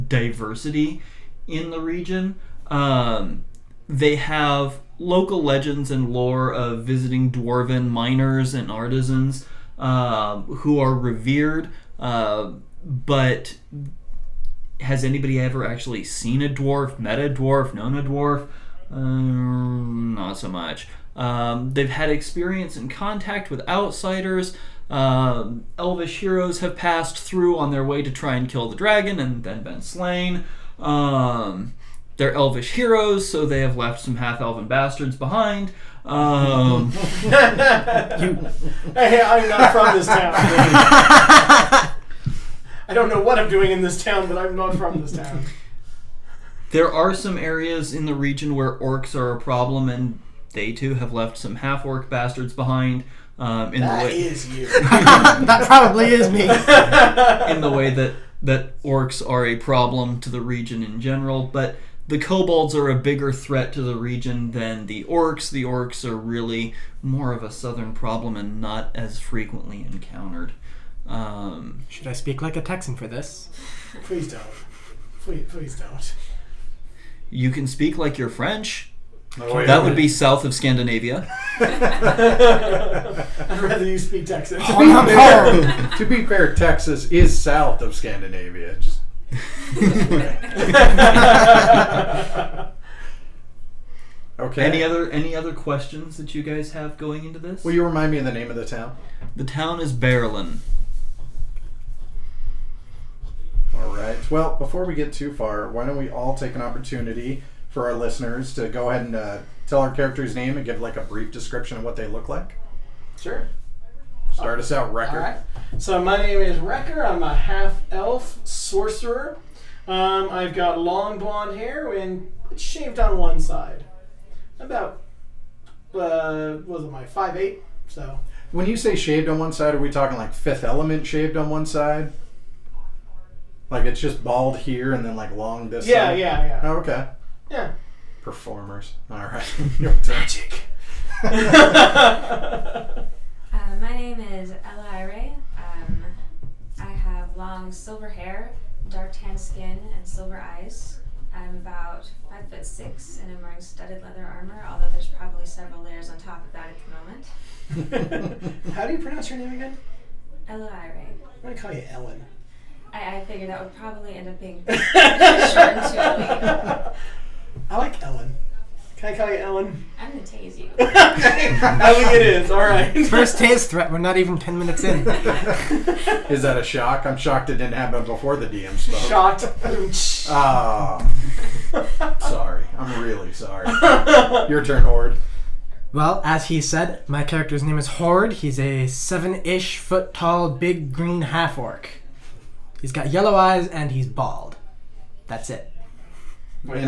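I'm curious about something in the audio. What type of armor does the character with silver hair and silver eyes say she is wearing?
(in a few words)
Studded leather armor.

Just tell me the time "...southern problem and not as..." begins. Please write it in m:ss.
1:07.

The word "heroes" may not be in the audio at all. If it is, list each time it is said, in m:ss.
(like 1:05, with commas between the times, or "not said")
0:26, 0:32.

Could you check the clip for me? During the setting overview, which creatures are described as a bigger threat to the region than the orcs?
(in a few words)
Kobolds.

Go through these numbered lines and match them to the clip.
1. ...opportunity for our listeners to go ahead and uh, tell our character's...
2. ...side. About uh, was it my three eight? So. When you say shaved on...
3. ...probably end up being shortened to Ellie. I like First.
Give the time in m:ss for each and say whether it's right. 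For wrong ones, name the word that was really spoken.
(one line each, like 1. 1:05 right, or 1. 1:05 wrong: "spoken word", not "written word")
1. 1:46 right
2. 2:03 wrong: "five", not "three"
3. 2:43 wrong: "Ellen", not "First".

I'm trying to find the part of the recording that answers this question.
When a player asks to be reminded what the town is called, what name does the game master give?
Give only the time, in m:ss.
1:39.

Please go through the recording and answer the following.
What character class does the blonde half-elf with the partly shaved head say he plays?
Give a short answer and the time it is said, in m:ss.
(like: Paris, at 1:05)
Sorcerer, at 1:58.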